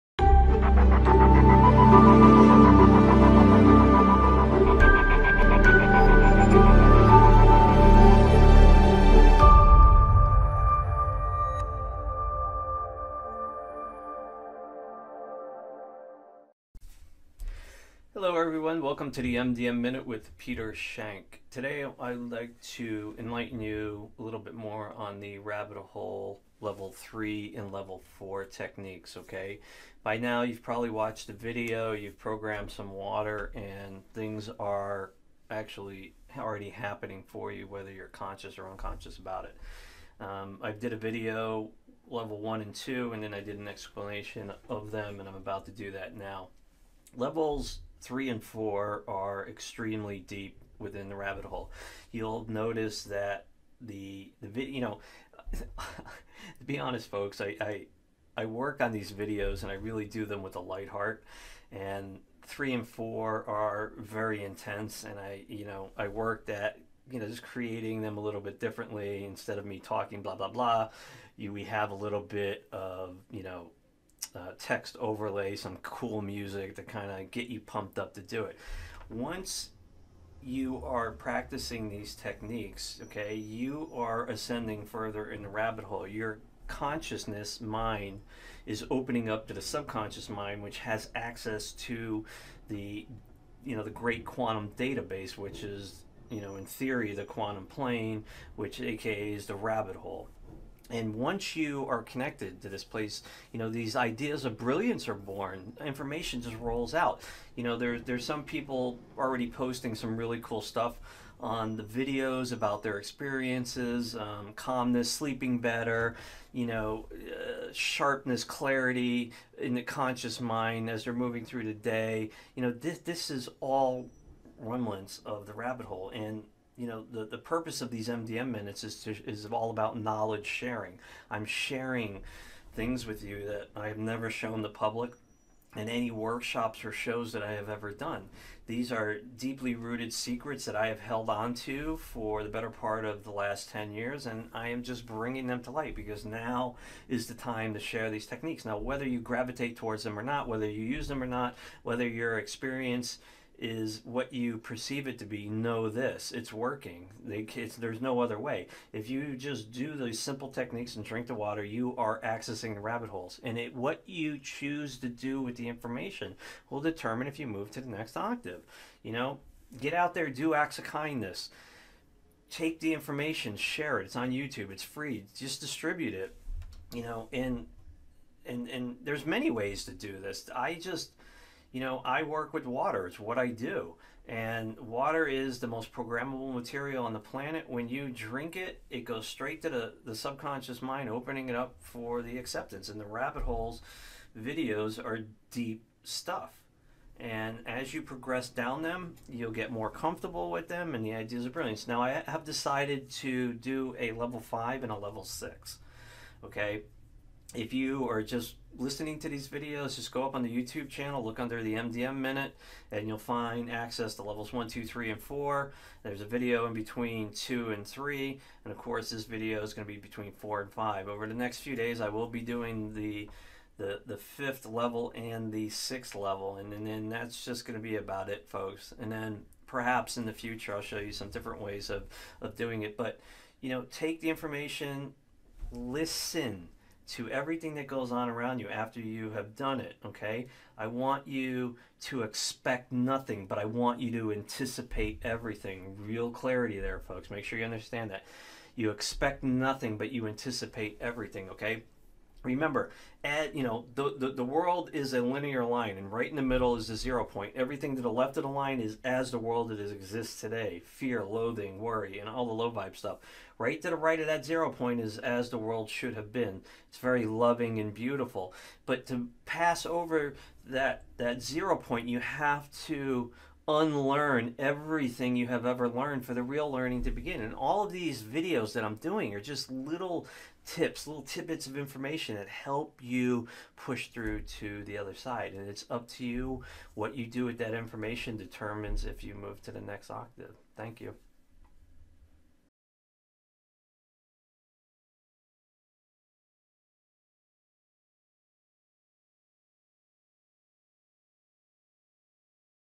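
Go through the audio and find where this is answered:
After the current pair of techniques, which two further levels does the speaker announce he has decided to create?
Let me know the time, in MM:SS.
03:23.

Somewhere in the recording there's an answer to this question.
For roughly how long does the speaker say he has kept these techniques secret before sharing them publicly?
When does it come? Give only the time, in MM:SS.
02:23.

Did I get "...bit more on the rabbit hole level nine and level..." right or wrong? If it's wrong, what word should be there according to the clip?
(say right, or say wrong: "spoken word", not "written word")
wrong: "three", not "nine".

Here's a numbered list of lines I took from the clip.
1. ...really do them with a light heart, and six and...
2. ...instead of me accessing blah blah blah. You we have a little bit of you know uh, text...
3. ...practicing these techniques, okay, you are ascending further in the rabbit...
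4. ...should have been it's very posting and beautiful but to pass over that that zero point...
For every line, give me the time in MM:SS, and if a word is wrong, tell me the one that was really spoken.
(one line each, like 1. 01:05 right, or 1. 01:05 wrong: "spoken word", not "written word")
1. 00:59 wrong: "three", not "six"
2. 01:09 wrong: "talking", not "accessing"
3. 01:21 right
4. 04:25 wrong: "loving", not "posting".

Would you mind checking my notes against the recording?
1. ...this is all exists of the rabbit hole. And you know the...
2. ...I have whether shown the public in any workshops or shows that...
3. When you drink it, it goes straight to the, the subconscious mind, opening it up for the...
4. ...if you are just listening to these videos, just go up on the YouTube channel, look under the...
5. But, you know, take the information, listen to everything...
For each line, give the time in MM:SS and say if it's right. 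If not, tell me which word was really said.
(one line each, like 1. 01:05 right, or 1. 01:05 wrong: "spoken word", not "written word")
1. 02:02 wrong: "remnants", not "exists"
2. 02:13 wrong: "never", not "whether"
3. 03:07 right
4. 03:27 right
5. 03:52 right.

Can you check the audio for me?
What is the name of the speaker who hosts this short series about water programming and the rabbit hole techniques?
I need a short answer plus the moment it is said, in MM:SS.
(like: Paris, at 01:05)
Peter Schenk, at 00:20.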